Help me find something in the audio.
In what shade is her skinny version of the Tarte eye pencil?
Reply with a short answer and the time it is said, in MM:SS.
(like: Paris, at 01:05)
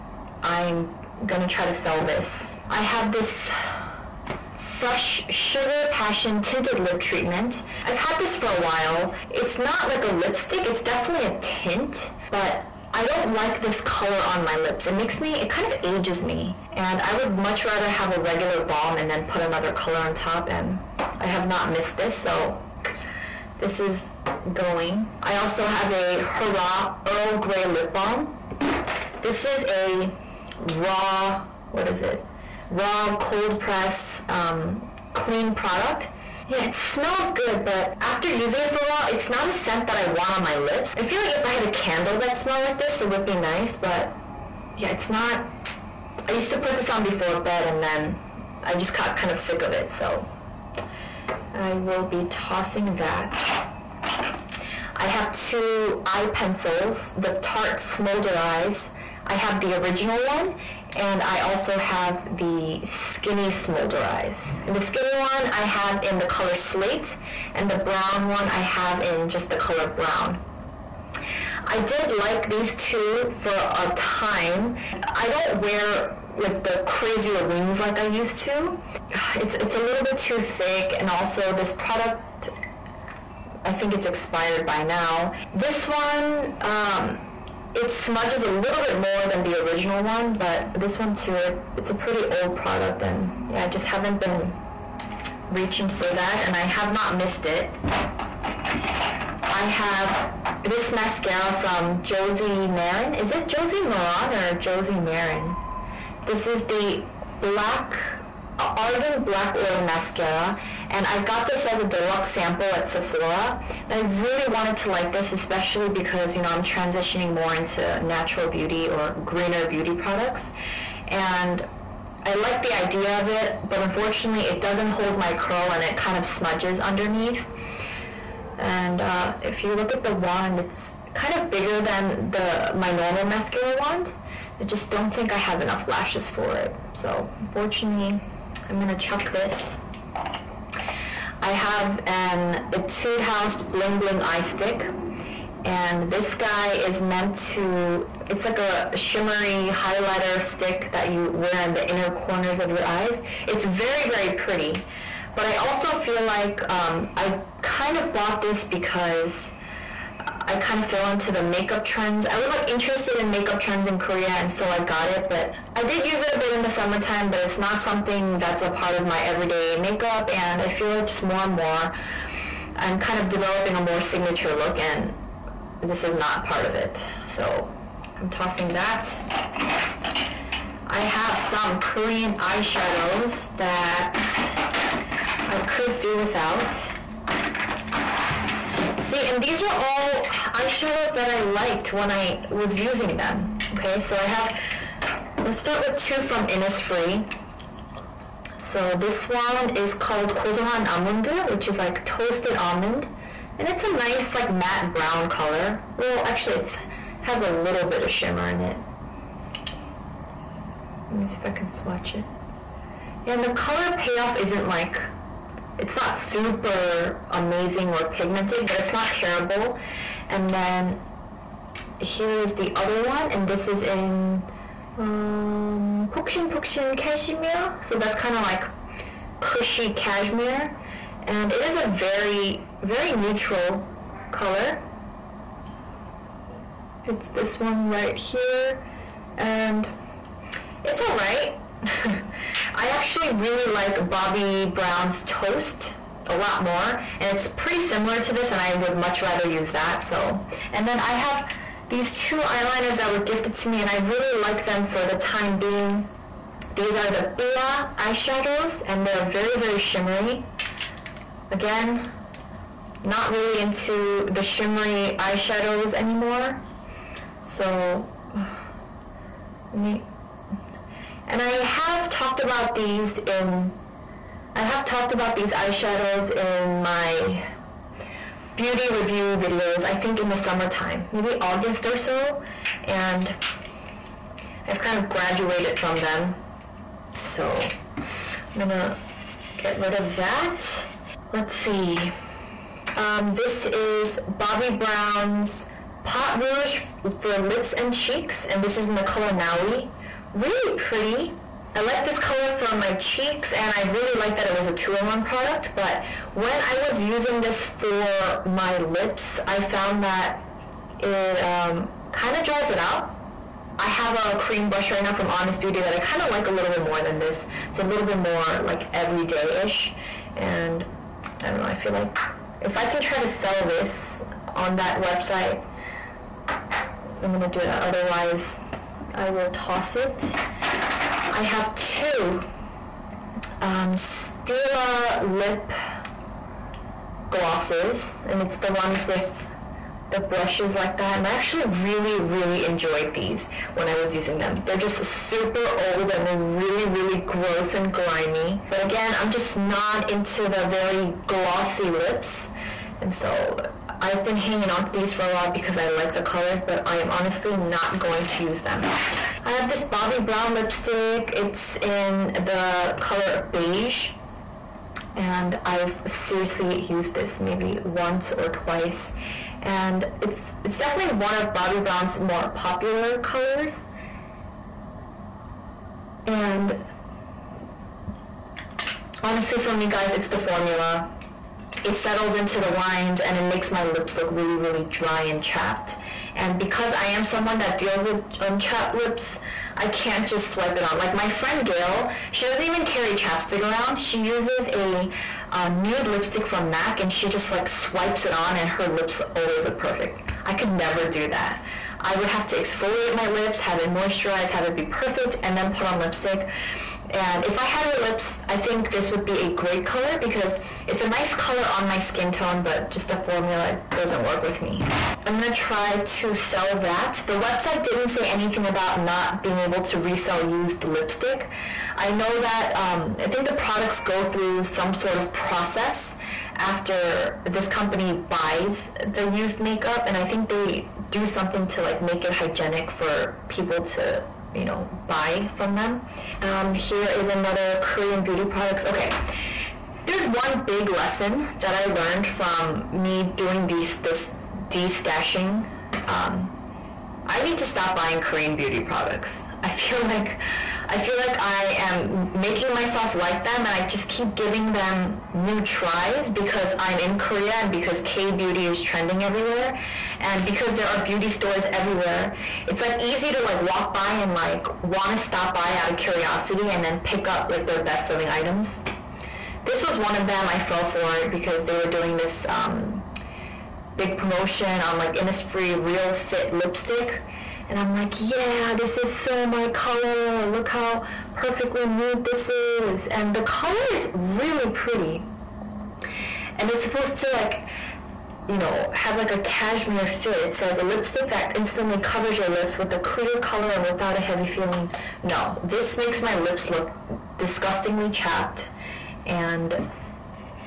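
Slate, at 01:06.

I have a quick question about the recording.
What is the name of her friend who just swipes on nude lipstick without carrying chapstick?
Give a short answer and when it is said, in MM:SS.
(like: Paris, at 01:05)
Gail, at 06:31.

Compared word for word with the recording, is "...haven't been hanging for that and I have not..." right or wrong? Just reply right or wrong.
wrong.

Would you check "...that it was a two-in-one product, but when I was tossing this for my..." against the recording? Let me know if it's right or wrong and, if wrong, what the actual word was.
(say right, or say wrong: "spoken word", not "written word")
wrong: "using", not "tossing".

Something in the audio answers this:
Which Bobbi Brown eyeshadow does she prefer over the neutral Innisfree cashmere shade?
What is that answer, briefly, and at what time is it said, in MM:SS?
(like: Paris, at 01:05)
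Toast, at 04:05.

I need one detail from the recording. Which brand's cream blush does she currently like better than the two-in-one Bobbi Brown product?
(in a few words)
Honest Beauty.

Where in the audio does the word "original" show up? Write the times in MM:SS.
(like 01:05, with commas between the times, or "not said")
00:59, 01:29.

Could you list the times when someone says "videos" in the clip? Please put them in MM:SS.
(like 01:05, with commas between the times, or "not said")
04:39.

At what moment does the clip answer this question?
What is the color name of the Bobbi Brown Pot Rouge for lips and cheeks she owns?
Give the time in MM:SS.
04:59.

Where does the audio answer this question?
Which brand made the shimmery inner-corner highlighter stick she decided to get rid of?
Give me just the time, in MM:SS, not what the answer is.
02:22.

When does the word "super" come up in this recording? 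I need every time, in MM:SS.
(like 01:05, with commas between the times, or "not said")
03:36, 05:45.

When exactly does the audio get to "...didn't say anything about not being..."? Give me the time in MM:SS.
06:57.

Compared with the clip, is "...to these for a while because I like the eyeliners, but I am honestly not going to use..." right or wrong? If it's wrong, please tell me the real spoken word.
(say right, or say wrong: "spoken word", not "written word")
wrong: "colors", not "eyeliners".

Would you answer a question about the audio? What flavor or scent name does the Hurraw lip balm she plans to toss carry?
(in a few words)
Earl Grey.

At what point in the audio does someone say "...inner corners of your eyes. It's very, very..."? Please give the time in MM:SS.
02:31.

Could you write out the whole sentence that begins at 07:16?
Um, here is another Korean beauty products.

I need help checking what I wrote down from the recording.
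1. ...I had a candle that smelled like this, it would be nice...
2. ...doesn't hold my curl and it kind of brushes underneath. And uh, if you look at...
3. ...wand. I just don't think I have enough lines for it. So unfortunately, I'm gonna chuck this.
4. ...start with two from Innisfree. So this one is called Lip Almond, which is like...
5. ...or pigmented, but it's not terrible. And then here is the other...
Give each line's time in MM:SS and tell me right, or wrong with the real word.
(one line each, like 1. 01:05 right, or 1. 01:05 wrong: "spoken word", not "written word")
1. 00:41 right
2. 02:04 wrong: "smudges", not "brushes"
3. 02:13 wrong: "lashes", not "lines"
4. 03:15 wrong: "Kozohan", not "Lip"
5. 03:37 right.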